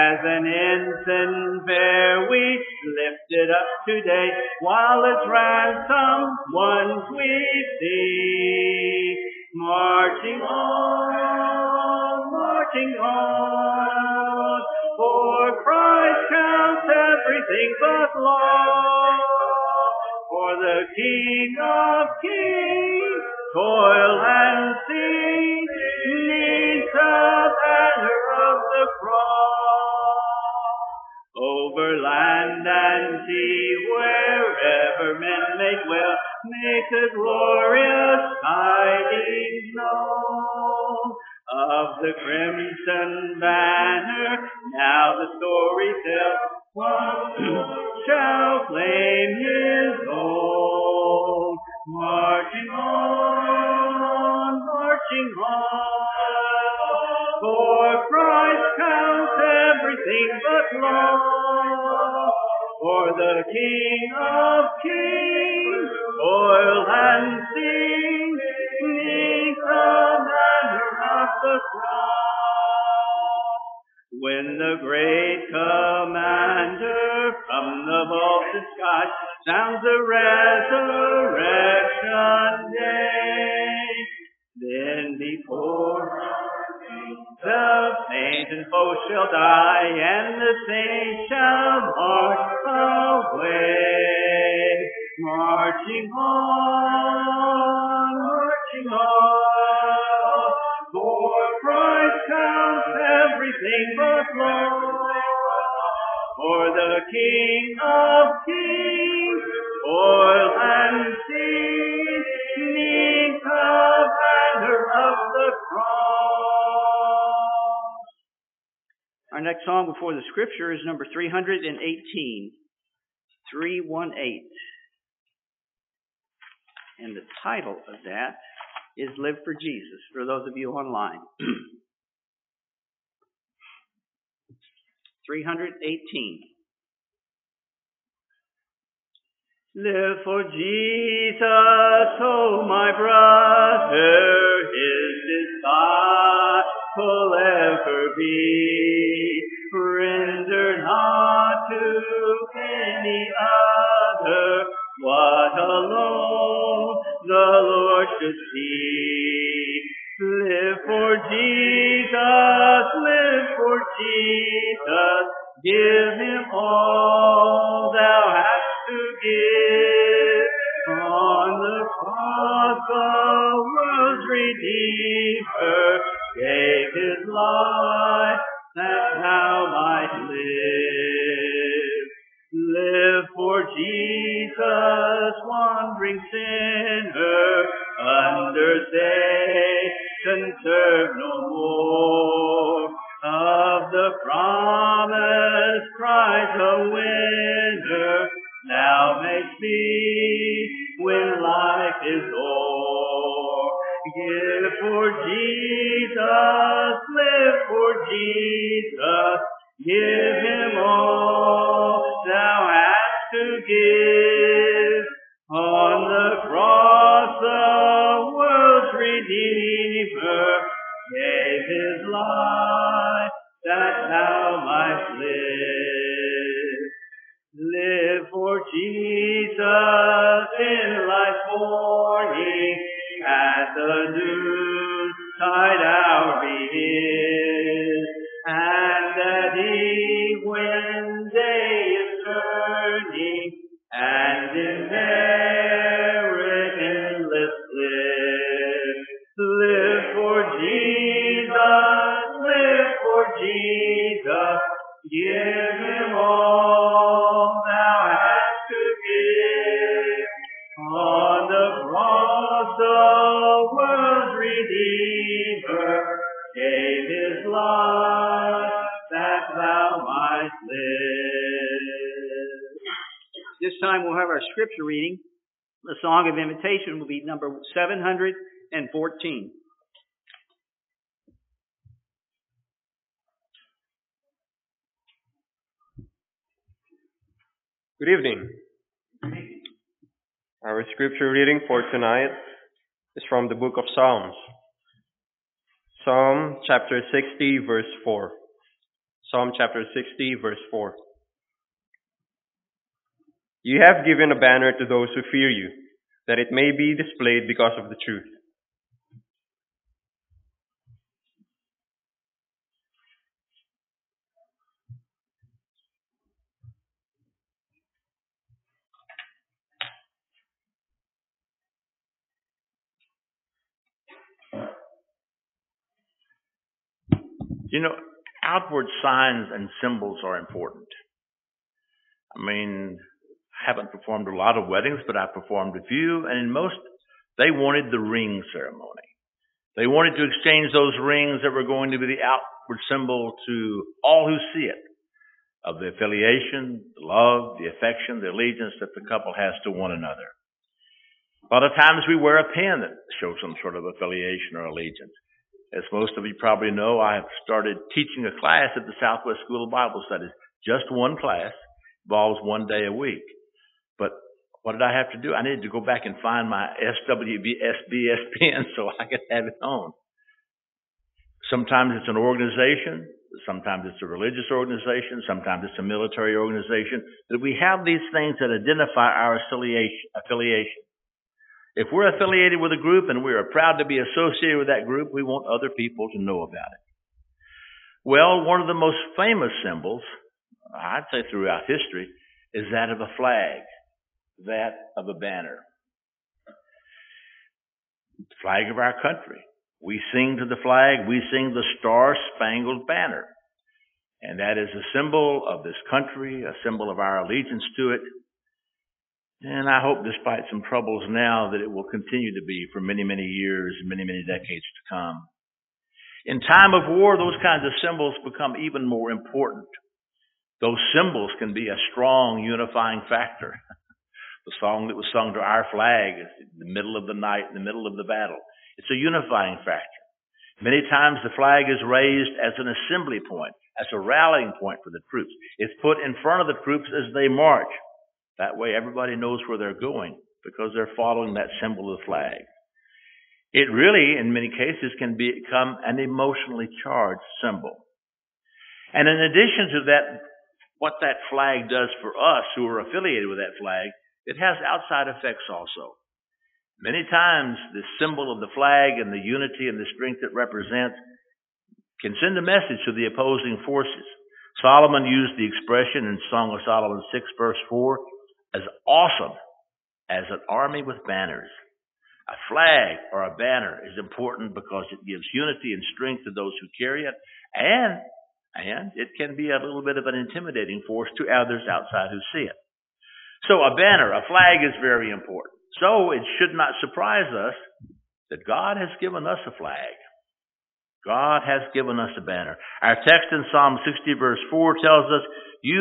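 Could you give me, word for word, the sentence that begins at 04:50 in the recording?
Our scripture reading for tonight is from the book of Psalms.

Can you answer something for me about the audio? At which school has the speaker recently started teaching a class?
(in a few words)
Southwest School of Bible Studies.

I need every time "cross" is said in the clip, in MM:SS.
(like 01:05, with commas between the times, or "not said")
00:28, 01:11, 01:55, 02:51.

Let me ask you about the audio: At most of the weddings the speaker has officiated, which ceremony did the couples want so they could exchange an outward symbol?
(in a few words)
ring ceremony.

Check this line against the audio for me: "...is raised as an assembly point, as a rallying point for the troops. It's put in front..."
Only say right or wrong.
right.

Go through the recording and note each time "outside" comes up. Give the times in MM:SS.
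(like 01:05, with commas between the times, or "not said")
07:34, 08:01.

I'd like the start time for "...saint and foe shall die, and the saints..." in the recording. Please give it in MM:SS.
01:28.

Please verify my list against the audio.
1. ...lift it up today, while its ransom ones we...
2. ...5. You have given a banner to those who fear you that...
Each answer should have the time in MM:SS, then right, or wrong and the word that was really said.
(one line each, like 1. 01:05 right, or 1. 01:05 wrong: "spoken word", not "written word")
1. 00:02 right
2. 05:00 wrong: "4", not "5".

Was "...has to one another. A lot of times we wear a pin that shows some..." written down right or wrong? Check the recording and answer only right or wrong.
right.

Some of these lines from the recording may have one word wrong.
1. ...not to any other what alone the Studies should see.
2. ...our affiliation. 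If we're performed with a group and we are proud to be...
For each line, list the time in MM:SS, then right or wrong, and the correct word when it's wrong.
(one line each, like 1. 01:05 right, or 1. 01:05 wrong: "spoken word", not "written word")
1. 02:30 wrong: "Lord", not "Studies"
2. 06:19 wrong: "affiliated", not "performed".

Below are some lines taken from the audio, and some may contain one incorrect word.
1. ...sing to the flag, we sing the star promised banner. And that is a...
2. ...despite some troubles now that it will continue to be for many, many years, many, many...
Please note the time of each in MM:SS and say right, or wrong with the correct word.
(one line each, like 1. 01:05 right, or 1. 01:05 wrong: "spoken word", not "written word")
1. 06:40 wrong: "spangled", not "promised"
2. 06:50 right.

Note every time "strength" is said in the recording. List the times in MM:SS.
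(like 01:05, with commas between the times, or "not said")
07:39, 07:55.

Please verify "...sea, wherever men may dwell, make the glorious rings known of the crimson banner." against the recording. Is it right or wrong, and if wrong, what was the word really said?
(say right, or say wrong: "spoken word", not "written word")
wrong: "tidings", not "rings".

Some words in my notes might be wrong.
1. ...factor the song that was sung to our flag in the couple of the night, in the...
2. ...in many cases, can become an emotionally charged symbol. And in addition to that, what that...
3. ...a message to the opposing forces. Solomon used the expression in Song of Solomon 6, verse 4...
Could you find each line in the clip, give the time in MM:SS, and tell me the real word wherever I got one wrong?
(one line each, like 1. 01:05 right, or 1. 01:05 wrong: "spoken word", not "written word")
1. 07:03 wrong: "middle", not "couple"
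2. 07:24 right
3. 07:42 right.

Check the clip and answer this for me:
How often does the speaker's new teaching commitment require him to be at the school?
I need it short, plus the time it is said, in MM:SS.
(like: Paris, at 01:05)
one day a week, at 06:02.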